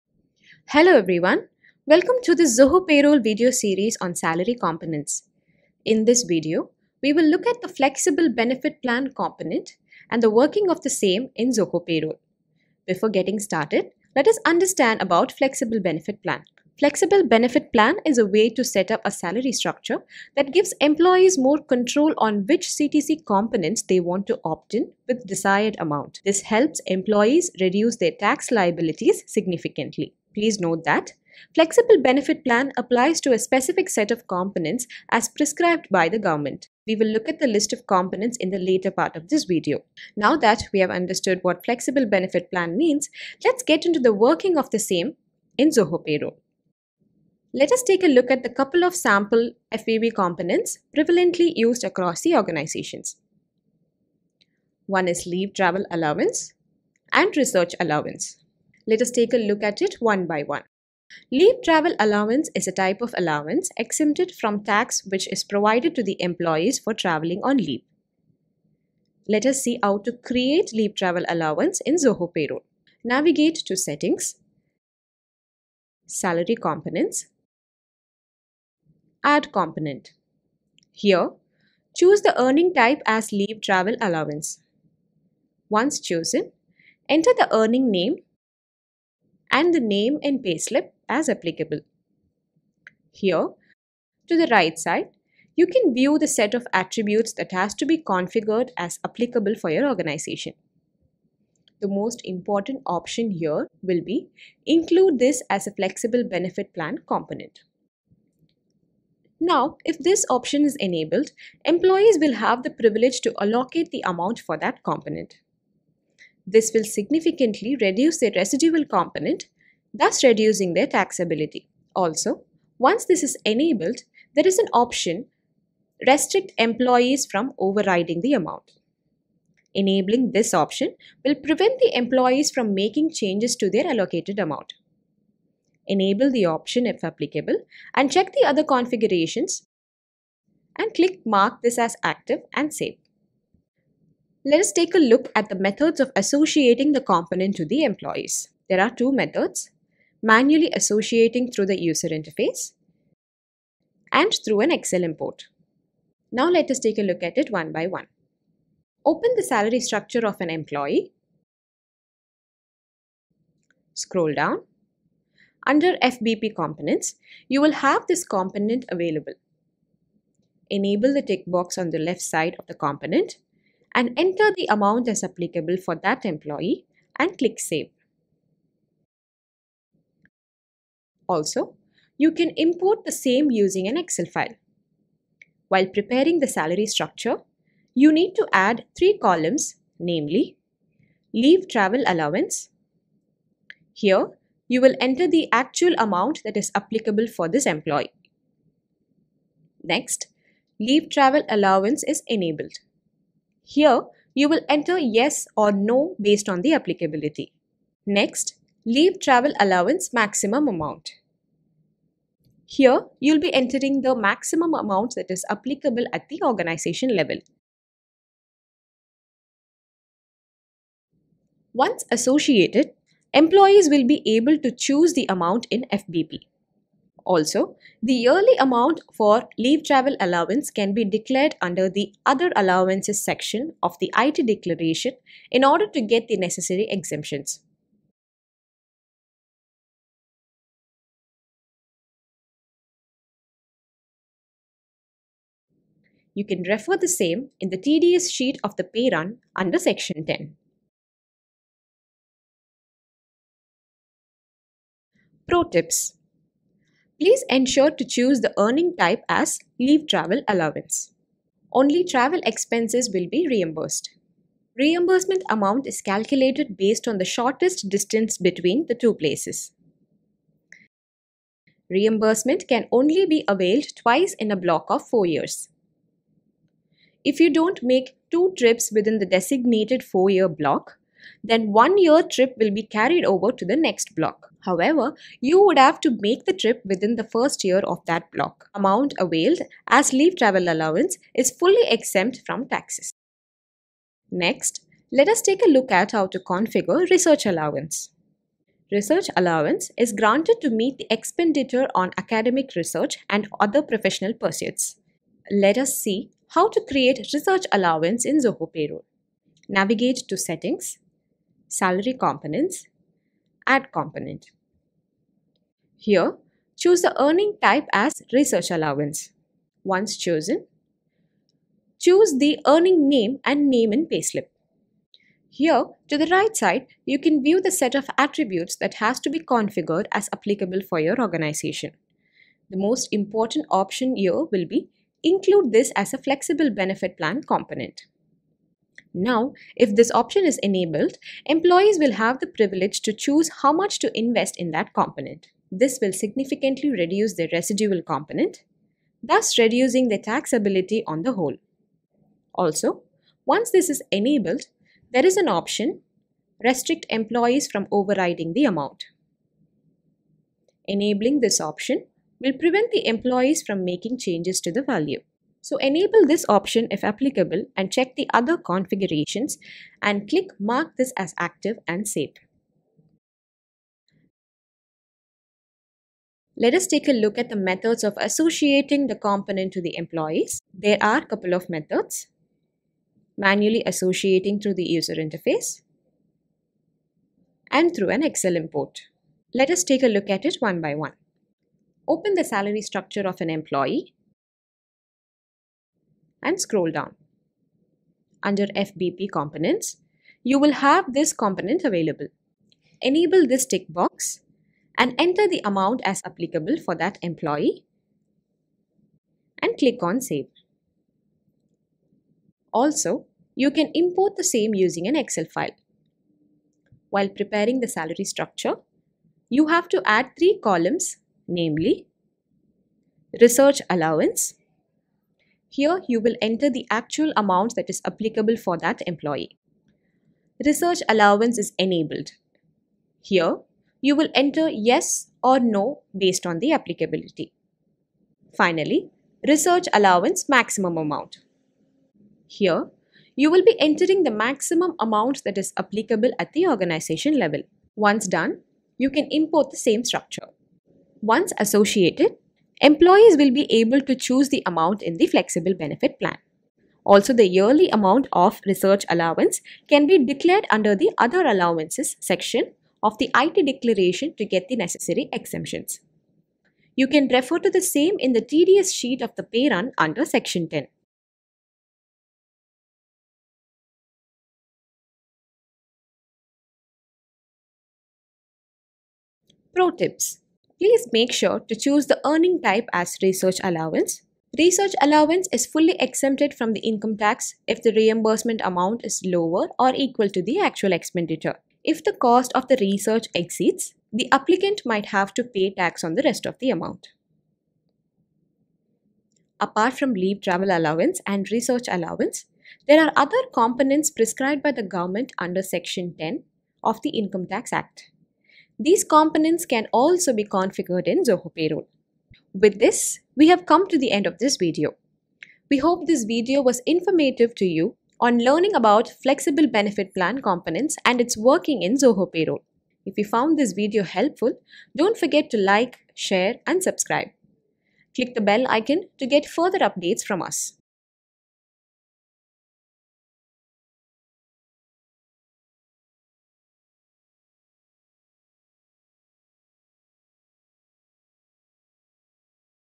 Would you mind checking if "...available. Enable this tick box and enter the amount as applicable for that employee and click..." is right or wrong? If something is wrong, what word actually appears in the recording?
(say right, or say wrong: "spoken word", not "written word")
right.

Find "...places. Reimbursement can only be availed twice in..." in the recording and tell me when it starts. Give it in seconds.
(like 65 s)
269 s.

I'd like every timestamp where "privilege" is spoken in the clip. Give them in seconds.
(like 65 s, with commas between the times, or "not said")
112 s, 342 s.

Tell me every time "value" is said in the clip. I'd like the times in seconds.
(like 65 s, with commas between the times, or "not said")
364 s.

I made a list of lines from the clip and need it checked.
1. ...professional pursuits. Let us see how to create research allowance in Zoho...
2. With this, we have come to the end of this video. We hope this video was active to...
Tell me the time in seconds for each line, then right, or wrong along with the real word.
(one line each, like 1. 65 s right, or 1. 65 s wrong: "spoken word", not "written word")
1. 303 s right
2. 512 s wrong: "informative", not "active".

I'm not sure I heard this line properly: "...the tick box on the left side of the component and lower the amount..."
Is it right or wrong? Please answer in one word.
wrong.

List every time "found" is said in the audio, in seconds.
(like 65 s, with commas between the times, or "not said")
523 s.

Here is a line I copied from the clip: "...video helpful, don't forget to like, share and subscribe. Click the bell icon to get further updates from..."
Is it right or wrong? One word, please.
right.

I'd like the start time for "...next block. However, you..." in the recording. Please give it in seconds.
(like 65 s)
283 s.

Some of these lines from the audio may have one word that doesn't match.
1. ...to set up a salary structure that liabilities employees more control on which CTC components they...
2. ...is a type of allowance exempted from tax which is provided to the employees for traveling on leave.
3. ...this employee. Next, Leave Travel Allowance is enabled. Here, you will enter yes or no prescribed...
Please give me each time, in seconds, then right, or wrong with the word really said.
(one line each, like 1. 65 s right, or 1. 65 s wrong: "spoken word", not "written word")
1. 18 s wrong: "gives", not "liabilities"
2. 62 s right
3. 197 s wrong: "based", not "prescribed".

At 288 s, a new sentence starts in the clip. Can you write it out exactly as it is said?
Amount availed as leave travel allowance is fully exempt from taxes.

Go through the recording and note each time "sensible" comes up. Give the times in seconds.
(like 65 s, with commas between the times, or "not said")
not said.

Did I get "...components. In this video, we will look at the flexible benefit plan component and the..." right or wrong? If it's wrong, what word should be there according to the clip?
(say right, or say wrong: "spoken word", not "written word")
right.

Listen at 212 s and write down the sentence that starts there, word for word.
Here, you'll be entering the maximum amount that is applicable at the organization level.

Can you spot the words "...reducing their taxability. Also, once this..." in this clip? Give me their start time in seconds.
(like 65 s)
120 s.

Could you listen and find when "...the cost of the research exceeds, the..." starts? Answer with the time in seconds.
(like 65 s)
492 s.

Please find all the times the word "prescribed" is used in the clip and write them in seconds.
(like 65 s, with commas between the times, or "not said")
35 s, 504 s.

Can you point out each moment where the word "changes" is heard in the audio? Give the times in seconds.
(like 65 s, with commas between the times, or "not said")
133 s, 364 s.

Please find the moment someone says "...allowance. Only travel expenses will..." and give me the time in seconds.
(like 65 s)
260 s.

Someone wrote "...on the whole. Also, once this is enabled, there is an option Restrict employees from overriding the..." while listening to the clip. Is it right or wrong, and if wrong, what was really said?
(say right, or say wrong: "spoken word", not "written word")
right.